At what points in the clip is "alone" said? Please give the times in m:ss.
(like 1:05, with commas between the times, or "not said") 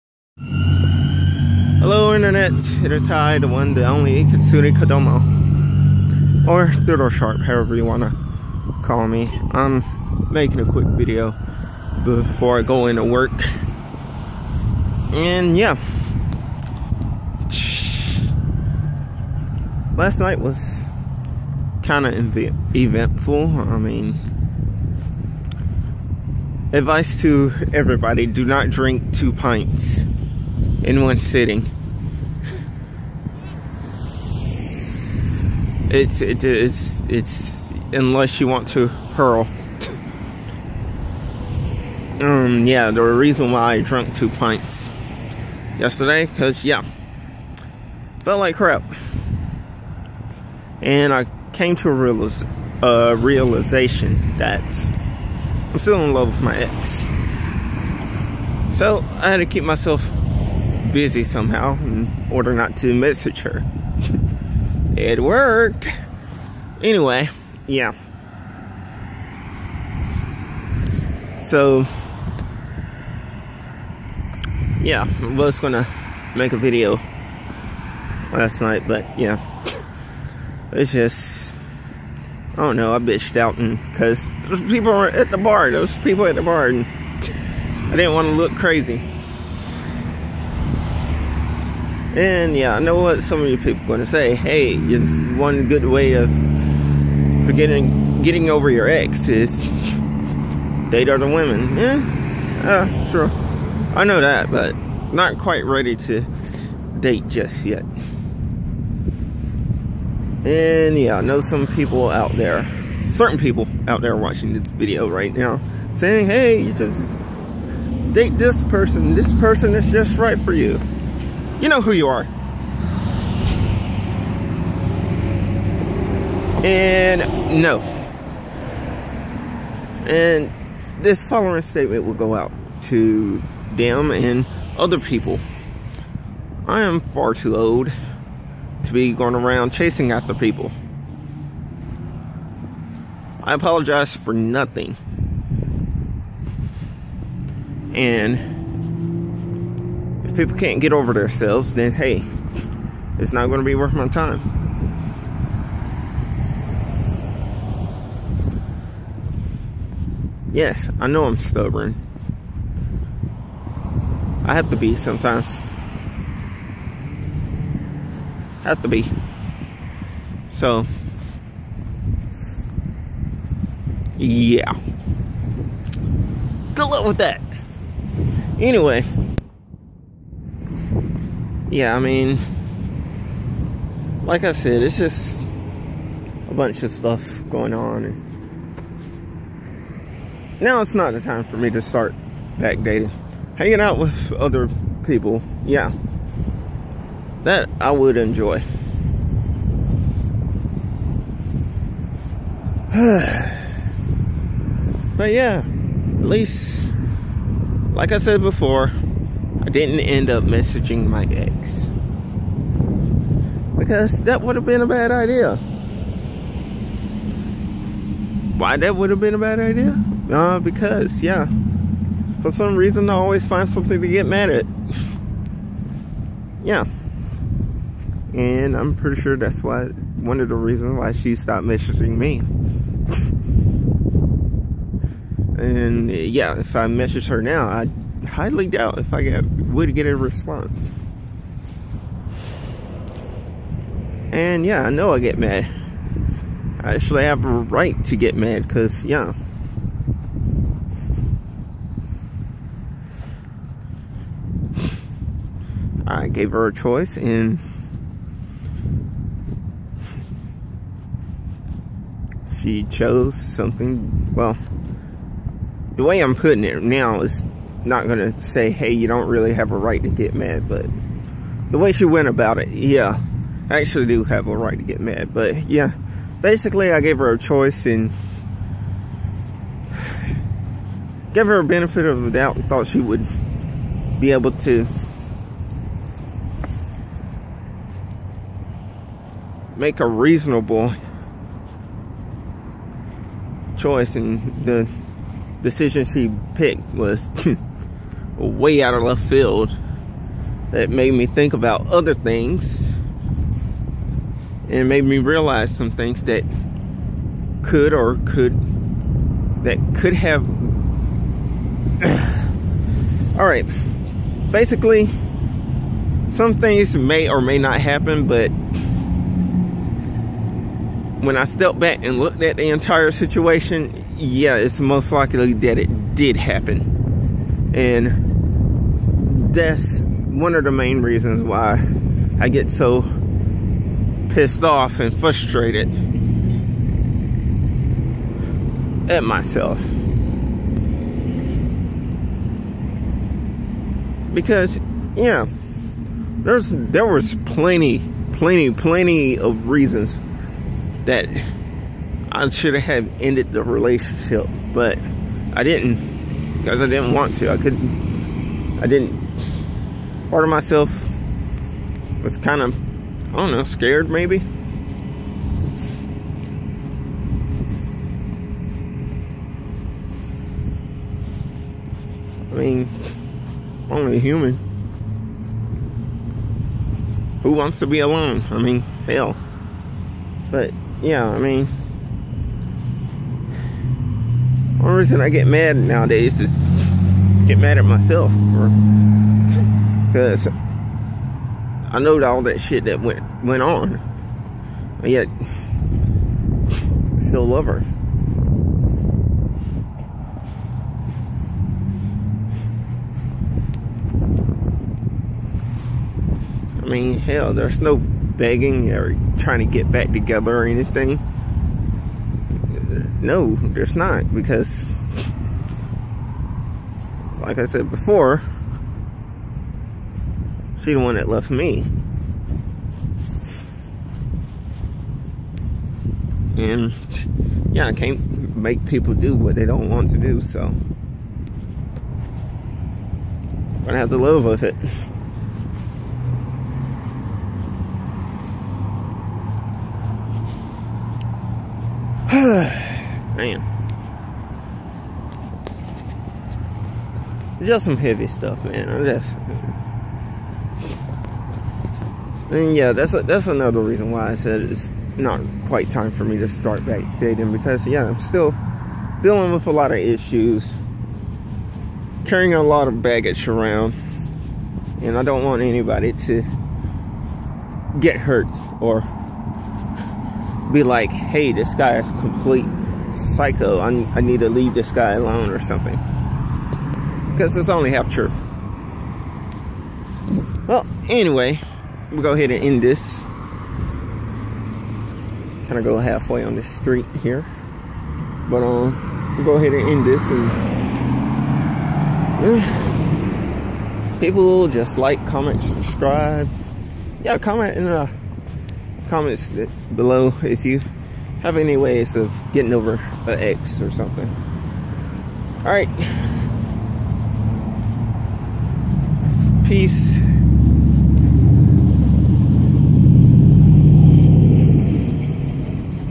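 6:17, 7:55.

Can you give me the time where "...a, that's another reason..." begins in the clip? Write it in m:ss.
7:33.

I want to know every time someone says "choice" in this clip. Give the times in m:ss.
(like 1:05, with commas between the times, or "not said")
4:16, 4:37, 4:53.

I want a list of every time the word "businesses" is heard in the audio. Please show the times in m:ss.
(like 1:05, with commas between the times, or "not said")
not said.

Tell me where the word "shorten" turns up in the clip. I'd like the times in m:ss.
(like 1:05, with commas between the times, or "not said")
not said.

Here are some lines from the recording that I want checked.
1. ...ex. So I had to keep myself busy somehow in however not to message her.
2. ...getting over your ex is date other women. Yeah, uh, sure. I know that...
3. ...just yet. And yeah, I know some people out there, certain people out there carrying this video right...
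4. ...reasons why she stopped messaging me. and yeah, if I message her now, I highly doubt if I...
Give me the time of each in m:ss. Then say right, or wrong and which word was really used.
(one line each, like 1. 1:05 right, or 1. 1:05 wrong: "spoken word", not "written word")
1. 0:56 wrong: "order", not "however"
2. 1:38 right
3. 1:47 wrong: "watching", not "carrying"
4. 3:50 right.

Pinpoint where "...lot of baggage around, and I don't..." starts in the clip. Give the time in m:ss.
7:42.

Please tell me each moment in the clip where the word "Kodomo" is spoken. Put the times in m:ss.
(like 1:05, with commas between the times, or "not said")
0:04.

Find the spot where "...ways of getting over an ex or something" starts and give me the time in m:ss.
8:21.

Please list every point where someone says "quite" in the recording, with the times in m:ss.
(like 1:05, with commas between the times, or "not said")
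1:45, 7:35.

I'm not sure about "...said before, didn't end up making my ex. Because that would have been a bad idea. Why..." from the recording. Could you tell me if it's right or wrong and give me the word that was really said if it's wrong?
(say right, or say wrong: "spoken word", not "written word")
wrong: "messaging", not "making".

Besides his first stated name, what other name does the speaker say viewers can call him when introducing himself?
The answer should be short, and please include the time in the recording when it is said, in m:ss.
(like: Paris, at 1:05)
Doodle Sharpe, at 0:06.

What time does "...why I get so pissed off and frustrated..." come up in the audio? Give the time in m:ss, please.
5:31.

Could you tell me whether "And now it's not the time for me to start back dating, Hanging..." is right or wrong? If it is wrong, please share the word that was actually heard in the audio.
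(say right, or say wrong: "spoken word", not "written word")
right.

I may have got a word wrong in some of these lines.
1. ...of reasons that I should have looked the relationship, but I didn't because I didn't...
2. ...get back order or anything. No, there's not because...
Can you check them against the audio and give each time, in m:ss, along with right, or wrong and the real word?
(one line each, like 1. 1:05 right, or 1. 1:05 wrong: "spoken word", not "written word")
1. 5:49 wrong: "ended", not "looked"
2. 6:49 wrong: "together", not "order".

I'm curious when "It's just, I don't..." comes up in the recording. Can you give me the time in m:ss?
1:20.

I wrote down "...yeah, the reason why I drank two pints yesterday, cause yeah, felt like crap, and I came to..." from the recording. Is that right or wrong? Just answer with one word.
right.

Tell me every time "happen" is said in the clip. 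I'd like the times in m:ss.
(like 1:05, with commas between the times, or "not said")
5:17, 5:26.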